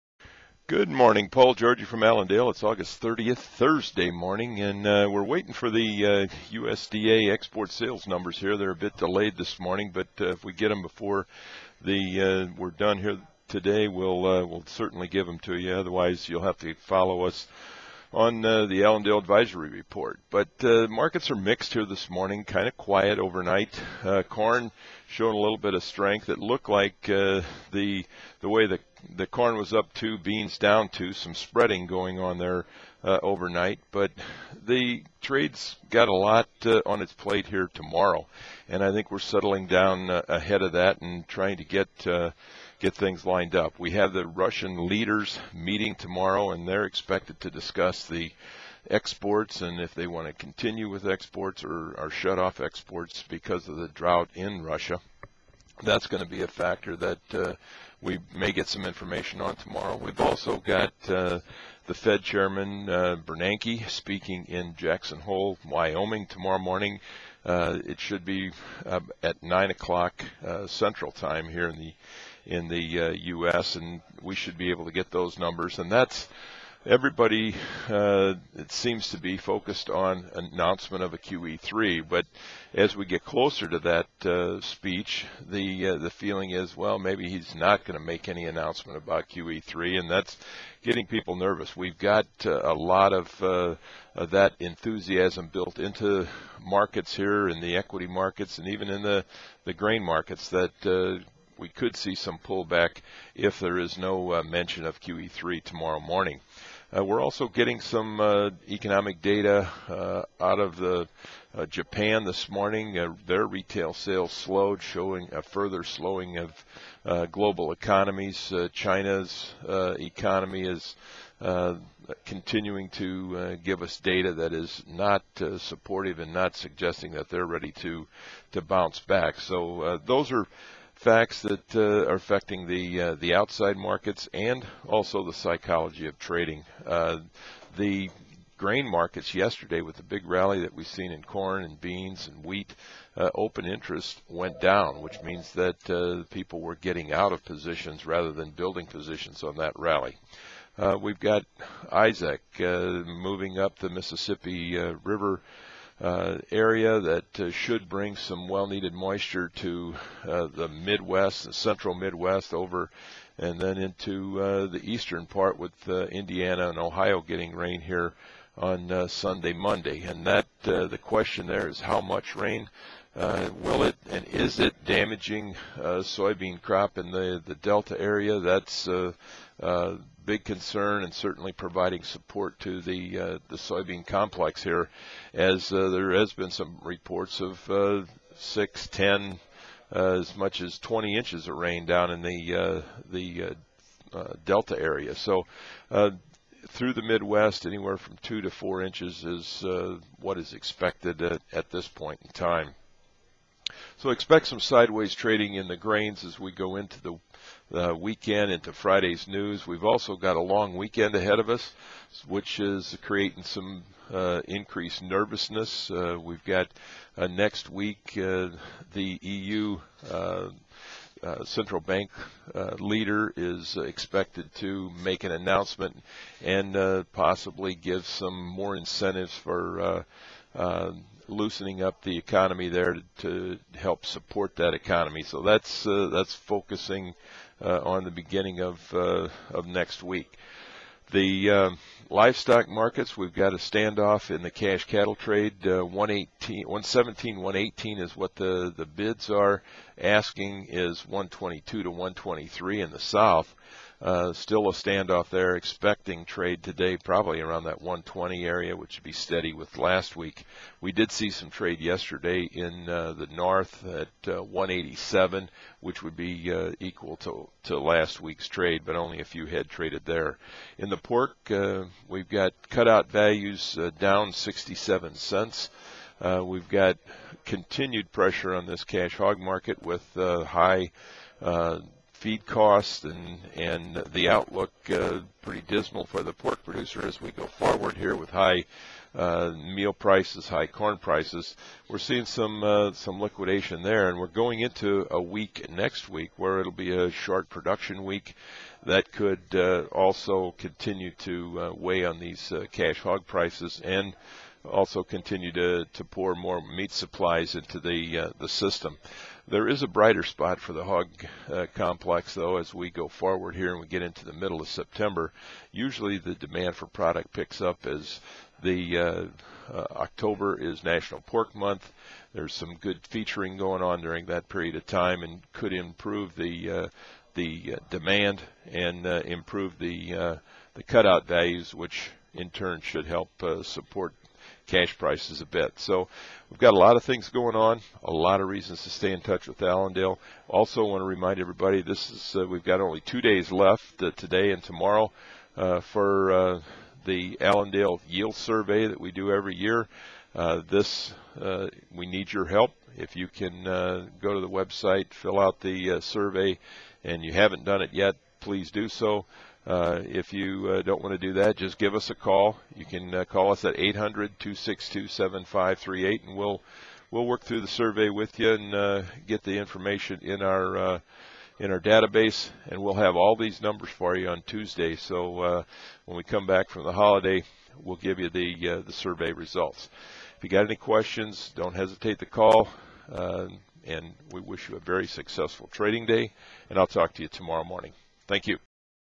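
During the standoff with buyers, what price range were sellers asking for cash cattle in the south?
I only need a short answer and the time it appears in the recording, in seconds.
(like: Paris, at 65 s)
122 to 123, at 251 s.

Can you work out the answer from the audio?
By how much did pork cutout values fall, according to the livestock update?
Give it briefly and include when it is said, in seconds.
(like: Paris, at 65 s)
67 cents, at 274 s.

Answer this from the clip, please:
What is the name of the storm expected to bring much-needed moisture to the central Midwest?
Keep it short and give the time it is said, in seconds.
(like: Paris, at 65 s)
Isaac, at 151 s.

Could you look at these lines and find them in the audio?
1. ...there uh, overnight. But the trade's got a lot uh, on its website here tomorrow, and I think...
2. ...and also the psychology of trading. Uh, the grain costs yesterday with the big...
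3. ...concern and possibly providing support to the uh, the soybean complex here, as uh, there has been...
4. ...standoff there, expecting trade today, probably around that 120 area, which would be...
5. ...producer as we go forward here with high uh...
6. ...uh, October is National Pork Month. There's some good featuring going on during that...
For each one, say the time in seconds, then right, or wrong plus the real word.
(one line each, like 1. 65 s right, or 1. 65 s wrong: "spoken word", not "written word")
1. 32 s wrong: "plate", not "website"
2. 134 s wrong: "markets", not "costs"
3. 180 s wrong: "certainly", not "possibly"
4. 254 s right
5. 286 s right
6. 319 s right.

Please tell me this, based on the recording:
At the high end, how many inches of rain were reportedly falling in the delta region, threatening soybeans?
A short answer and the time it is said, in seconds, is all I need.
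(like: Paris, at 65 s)
20, at 190 s.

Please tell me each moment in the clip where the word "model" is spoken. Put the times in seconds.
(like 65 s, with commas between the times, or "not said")
not said.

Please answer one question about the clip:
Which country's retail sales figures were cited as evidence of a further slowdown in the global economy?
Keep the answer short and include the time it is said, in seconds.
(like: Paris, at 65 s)
Japan, at 111 s.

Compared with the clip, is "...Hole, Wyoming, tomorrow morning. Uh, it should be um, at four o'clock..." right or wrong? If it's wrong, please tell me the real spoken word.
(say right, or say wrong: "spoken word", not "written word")
wrong: "nine", not "four".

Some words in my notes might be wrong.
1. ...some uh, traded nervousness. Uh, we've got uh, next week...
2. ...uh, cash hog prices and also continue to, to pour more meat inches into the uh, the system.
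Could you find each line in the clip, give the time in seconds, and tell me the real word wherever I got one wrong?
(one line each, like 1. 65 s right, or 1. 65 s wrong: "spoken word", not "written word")
1. 213 s wrong: "increased", not "traded"
2. 302 s wrong: "supplies", not "inches".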